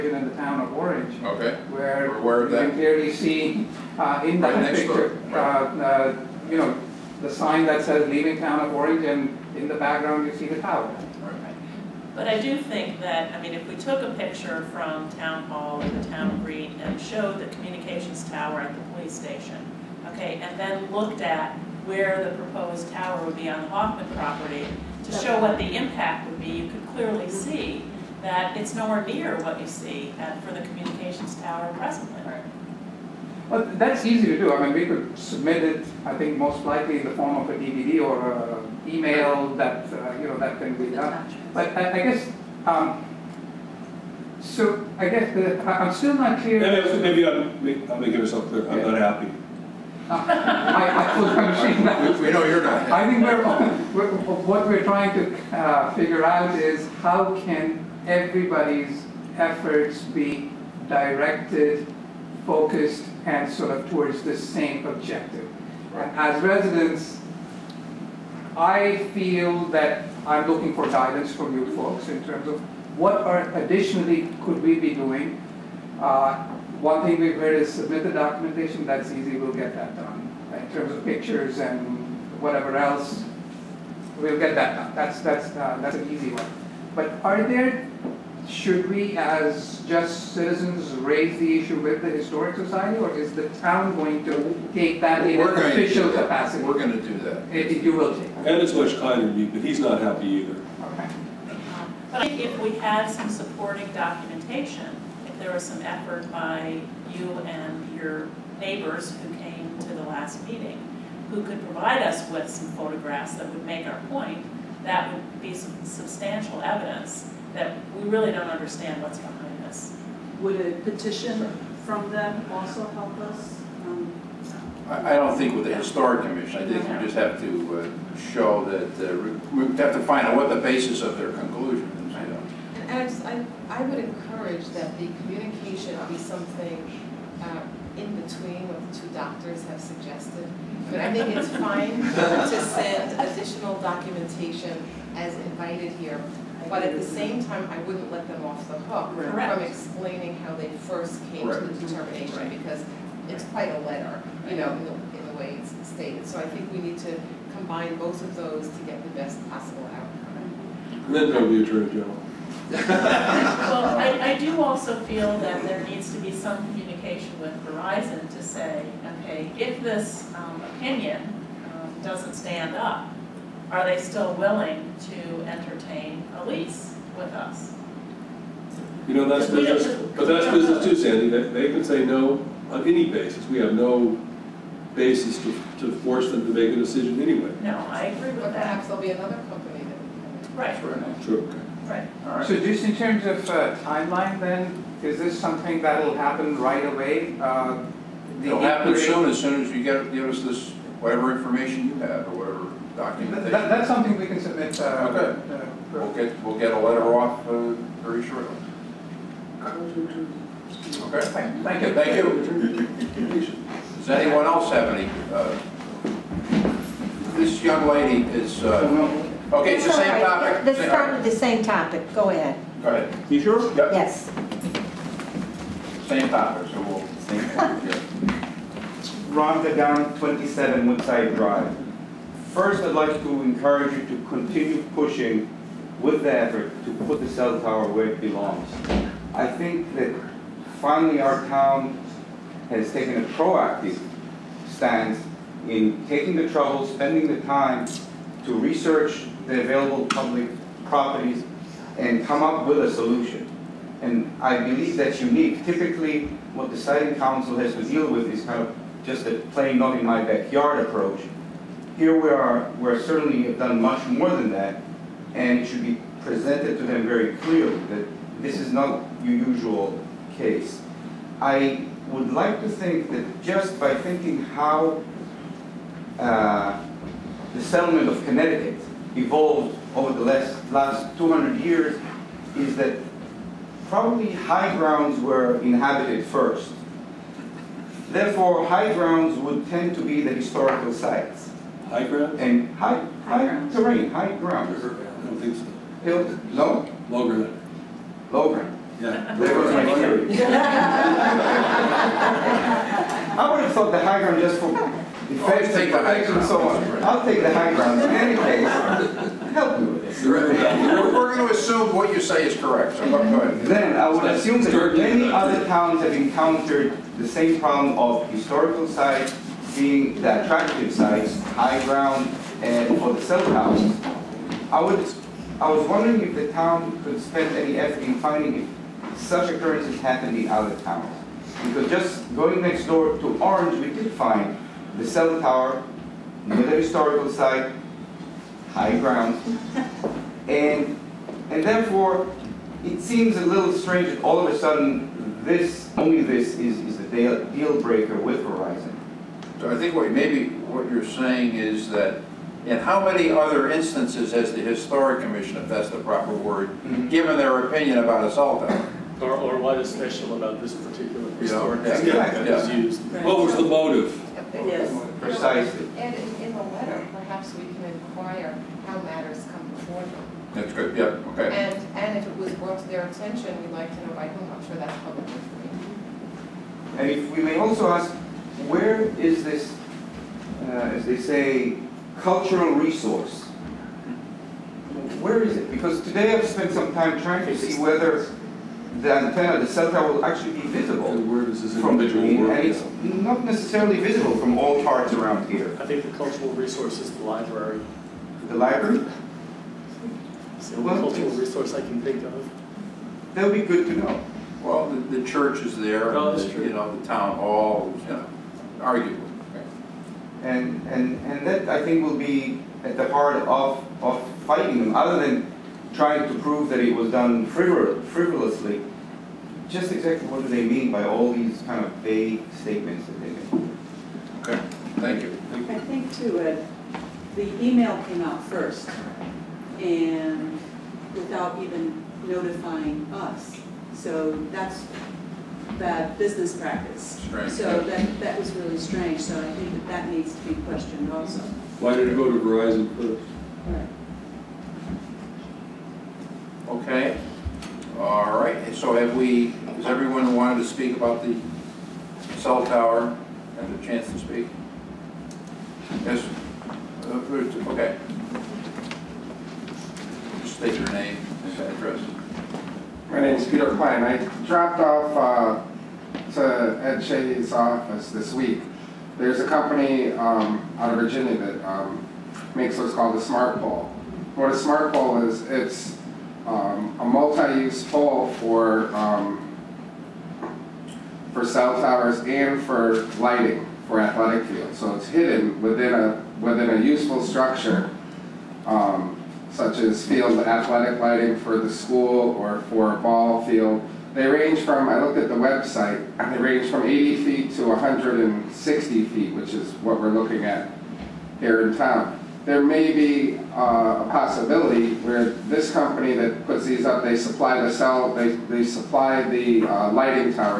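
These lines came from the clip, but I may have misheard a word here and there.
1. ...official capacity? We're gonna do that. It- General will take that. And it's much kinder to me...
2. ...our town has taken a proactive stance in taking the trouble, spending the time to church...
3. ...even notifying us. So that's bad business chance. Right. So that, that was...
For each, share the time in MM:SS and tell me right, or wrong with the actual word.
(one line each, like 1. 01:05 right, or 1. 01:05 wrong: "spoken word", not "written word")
1. 01:35 wrong: "You", not "General"
2. 04:01 wrong: "research", not "church"
3. 07:11 wrong: "practice", not "chance".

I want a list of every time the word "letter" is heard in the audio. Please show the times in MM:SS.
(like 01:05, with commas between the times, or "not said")
02:33, 03:26, 06:06.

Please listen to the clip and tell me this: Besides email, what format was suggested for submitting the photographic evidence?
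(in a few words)
DVD.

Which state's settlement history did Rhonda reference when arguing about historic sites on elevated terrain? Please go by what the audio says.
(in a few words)
Connecticut.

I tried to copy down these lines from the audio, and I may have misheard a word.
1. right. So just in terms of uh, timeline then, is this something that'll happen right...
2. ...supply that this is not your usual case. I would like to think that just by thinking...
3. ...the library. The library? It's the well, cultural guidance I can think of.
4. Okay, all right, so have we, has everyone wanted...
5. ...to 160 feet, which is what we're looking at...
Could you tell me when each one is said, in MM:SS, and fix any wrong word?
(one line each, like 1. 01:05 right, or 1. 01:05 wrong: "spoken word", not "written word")
1. 03:11 right
2. 04:27 wrong: "clearly", not "supply"
3. 06:37 wrong: "resource", not "guidance"
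4. 07:26 right
5. 08:17 right.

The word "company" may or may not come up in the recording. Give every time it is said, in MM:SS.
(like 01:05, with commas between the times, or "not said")
03:09, 07:49, 08:25.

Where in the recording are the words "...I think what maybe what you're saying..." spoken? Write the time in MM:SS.
05:49.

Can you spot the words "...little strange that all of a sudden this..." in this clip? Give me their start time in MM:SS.
05:43.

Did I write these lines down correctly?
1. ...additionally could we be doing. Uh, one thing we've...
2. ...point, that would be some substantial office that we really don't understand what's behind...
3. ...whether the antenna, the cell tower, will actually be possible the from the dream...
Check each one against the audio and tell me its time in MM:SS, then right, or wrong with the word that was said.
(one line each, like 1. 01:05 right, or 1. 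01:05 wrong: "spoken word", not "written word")
1. 01:13 right
2. 01:54 wrong: "evidence", not "office"
3. 06:27 wrong: "visible", not "possible".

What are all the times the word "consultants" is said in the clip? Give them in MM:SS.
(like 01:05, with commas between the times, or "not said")
not said.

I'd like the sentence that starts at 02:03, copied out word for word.
Um, I, don't think with the historic commission.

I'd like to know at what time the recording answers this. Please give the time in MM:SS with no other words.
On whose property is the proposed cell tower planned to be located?
00:23.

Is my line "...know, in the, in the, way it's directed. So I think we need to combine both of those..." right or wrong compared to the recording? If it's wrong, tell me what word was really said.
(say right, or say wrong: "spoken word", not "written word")
wrong: "stated", not "directed".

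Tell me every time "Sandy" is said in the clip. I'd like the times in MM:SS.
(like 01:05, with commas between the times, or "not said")
03:00.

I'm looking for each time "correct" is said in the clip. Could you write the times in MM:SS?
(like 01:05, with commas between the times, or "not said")
02:29, 05:12.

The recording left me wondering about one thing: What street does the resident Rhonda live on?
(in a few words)
Woodside Drive.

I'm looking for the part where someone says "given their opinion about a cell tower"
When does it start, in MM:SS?
05:57.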